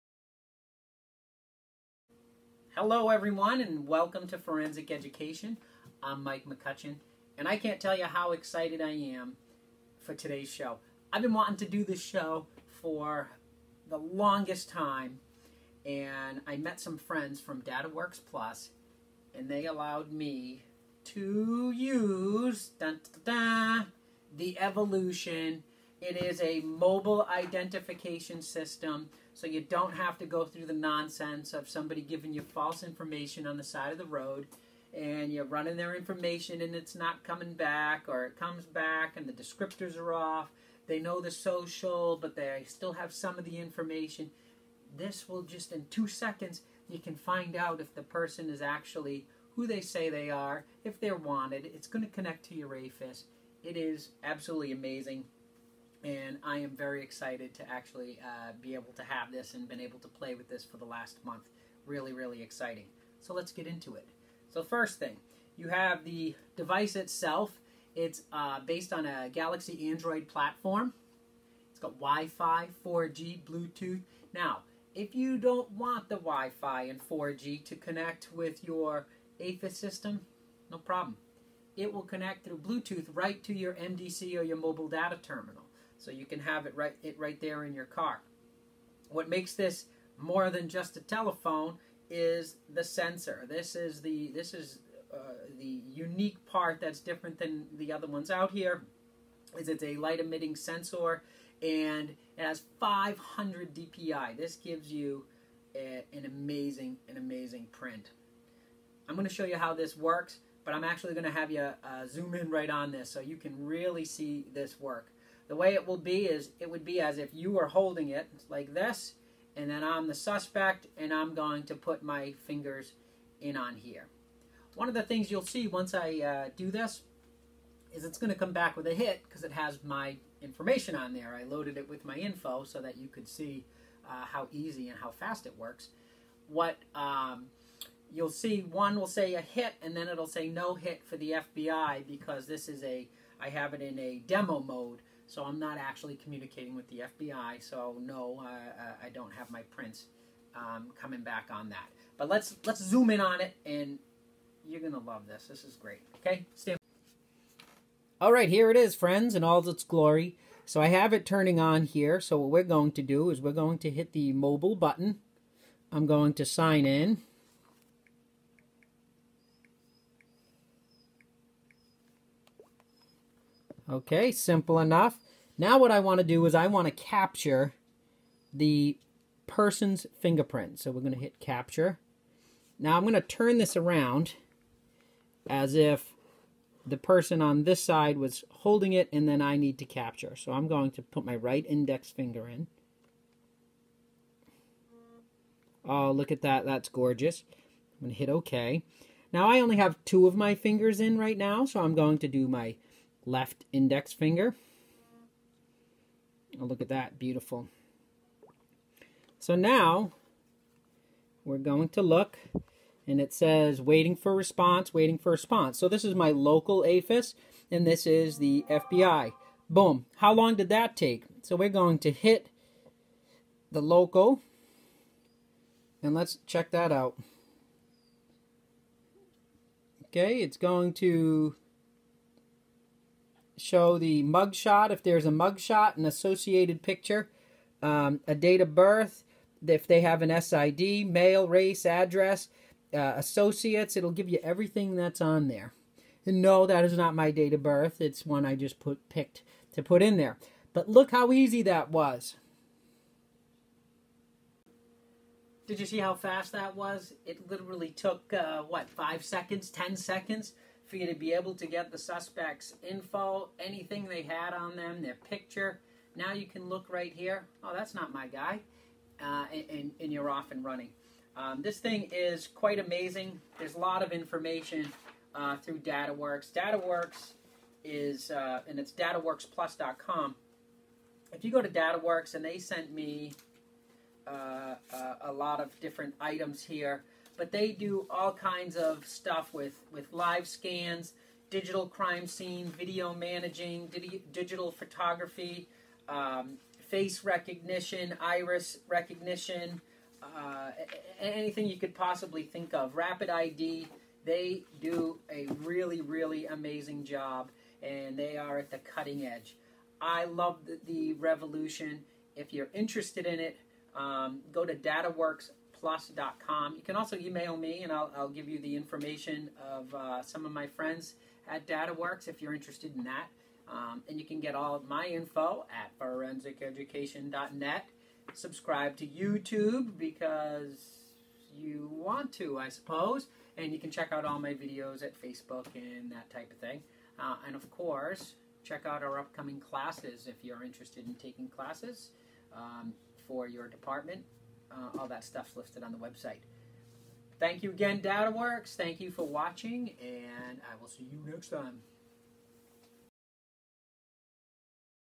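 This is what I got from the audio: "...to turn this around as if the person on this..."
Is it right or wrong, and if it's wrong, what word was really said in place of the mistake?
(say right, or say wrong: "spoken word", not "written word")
right.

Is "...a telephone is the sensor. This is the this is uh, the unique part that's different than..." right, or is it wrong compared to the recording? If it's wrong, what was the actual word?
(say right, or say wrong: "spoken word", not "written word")
right.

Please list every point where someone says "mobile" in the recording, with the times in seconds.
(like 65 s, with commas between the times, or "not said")
26 s, 84 s, 164 s.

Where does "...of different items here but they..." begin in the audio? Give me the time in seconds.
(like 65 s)
285 s.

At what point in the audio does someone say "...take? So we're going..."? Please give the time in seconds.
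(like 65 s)
220 s.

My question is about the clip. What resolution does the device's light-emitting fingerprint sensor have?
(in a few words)
500 DPI.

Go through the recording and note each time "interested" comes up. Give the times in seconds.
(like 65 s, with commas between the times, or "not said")
312 s, 322 s, 340 s.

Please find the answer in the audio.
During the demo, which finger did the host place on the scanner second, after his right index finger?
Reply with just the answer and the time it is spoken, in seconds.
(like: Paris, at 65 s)
Left index finger, at 203 s.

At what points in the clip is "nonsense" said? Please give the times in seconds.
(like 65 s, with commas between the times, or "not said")
30 s.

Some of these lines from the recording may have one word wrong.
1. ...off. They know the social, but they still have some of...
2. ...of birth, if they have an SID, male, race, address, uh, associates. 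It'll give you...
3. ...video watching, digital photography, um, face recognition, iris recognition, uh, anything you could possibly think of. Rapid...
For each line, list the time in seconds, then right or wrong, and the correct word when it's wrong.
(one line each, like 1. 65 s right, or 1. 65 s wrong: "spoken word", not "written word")
1. 40 s right
2. 238 s right
3. 292 s wrong: "managing", not "watching".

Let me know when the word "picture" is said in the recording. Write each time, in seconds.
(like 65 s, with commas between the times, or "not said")
236 s, 265 s.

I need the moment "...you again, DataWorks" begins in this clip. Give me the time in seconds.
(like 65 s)
347 s.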